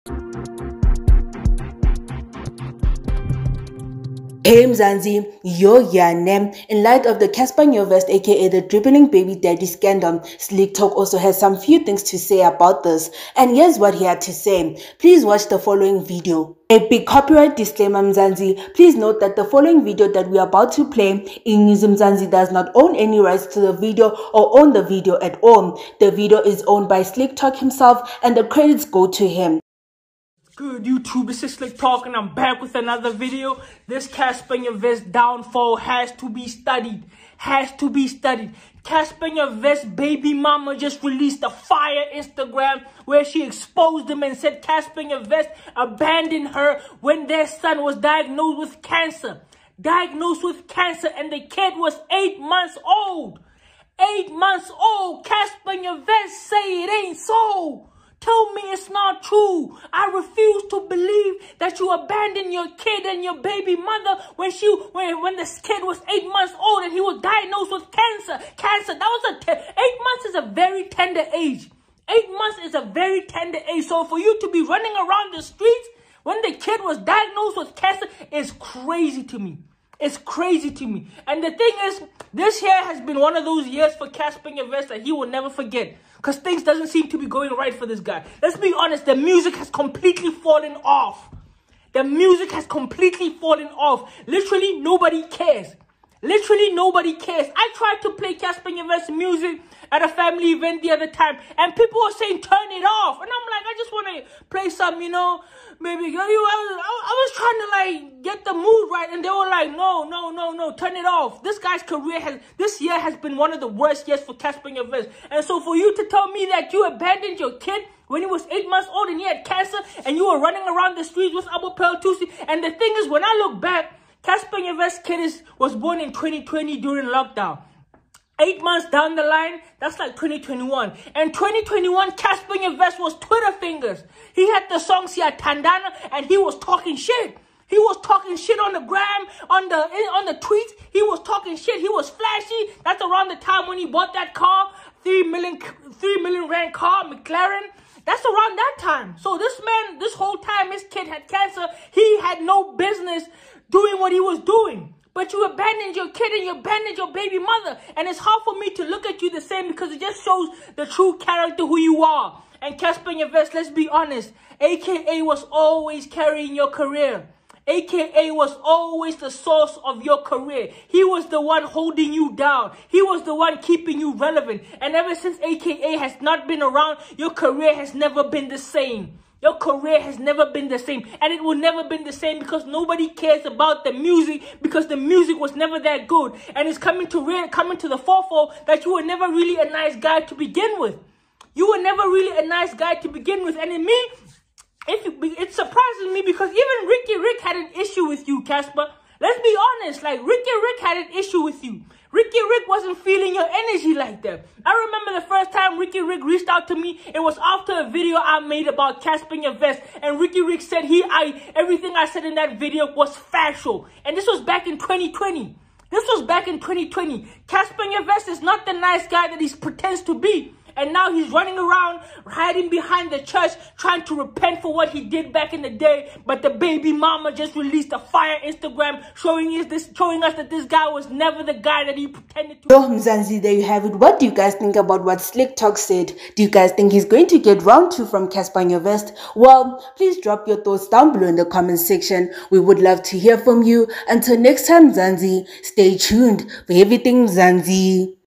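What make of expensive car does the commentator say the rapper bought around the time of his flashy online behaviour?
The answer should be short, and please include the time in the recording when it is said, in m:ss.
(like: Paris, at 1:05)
McLaren, at 2:27.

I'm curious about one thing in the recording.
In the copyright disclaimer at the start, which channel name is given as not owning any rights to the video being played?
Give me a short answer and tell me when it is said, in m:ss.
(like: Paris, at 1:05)
Inyuzu Mzansi, at 0:21.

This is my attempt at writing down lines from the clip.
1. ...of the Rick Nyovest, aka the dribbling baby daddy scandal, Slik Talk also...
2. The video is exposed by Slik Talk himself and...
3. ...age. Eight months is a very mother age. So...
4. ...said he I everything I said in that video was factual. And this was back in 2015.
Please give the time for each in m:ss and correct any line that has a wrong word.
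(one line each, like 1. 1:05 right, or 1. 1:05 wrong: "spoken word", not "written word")
1. 0:07 wrong: "Cassper", not "Rick"
2. 0:26 wrong: "owned", not "exposed"
3. 1:11 wrong: "tender", not "mother"
4. 3:30 wrong: "2020", not "2015".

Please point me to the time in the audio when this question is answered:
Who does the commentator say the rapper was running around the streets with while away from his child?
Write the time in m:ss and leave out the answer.
2:01.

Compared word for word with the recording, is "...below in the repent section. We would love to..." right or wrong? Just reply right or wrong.
wrong.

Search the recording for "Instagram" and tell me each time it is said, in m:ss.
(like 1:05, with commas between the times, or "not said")
0:42, 3:48.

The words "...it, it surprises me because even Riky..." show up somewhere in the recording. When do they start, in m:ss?
3:14.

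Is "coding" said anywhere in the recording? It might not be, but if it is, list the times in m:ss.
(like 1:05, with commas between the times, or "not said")
not said.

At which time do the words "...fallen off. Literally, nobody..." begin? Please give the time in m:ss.
1:33.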